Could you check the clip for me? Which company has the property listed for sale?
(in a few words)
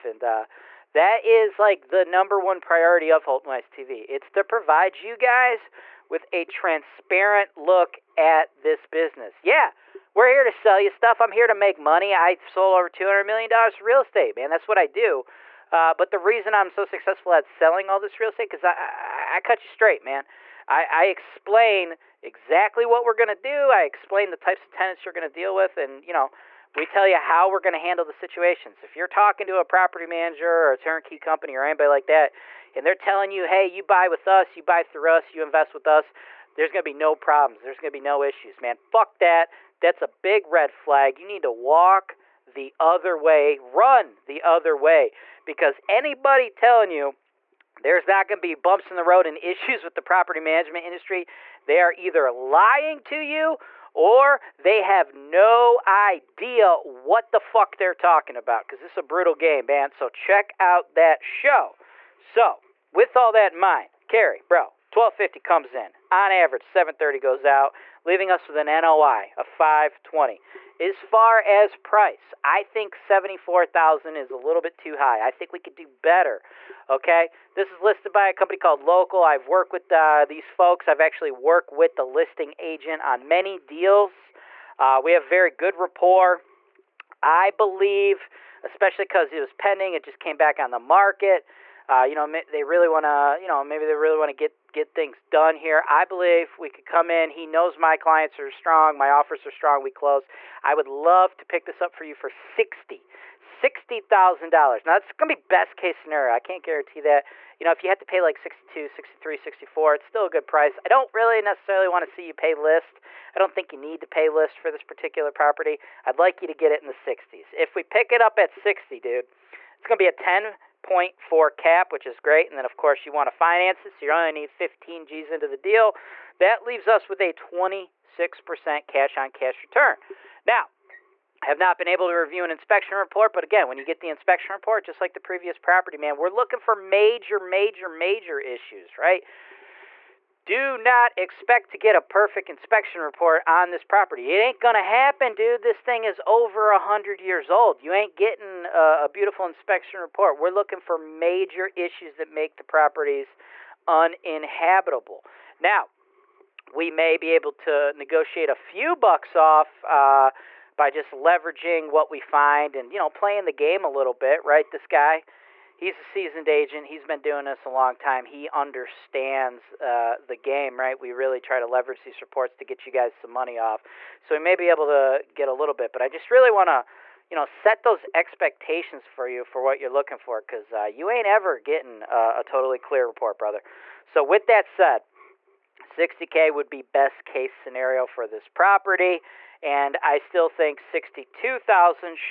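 Local.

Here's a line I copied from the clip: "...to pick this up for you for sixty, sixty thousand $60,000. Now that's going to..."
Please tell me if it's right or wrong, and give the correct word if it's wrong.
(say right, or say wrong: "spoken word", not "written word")
right.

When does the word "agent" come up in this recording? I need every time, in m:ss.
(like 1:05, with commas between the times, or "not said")
1:22, 2:46.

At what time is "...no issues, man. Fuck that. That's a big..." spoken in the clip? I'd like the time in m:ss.
0:37.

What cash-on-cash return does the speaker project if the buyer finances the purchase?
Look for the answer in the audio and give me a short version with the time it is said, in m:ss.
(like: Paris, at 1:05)
26%, at 2:07.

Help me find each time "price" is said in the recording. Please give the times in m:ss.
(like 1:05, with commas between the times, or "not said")
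1:11, 1:50.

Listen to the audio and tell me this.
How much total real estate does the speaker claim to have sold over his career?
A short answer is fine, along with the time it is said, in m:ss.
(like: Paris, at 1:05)
Over $200 million, at 0:12.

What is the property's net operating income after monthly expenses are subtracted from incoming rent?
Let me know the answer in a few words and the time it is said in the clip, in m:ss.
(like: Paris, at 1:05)
520, at 1:08.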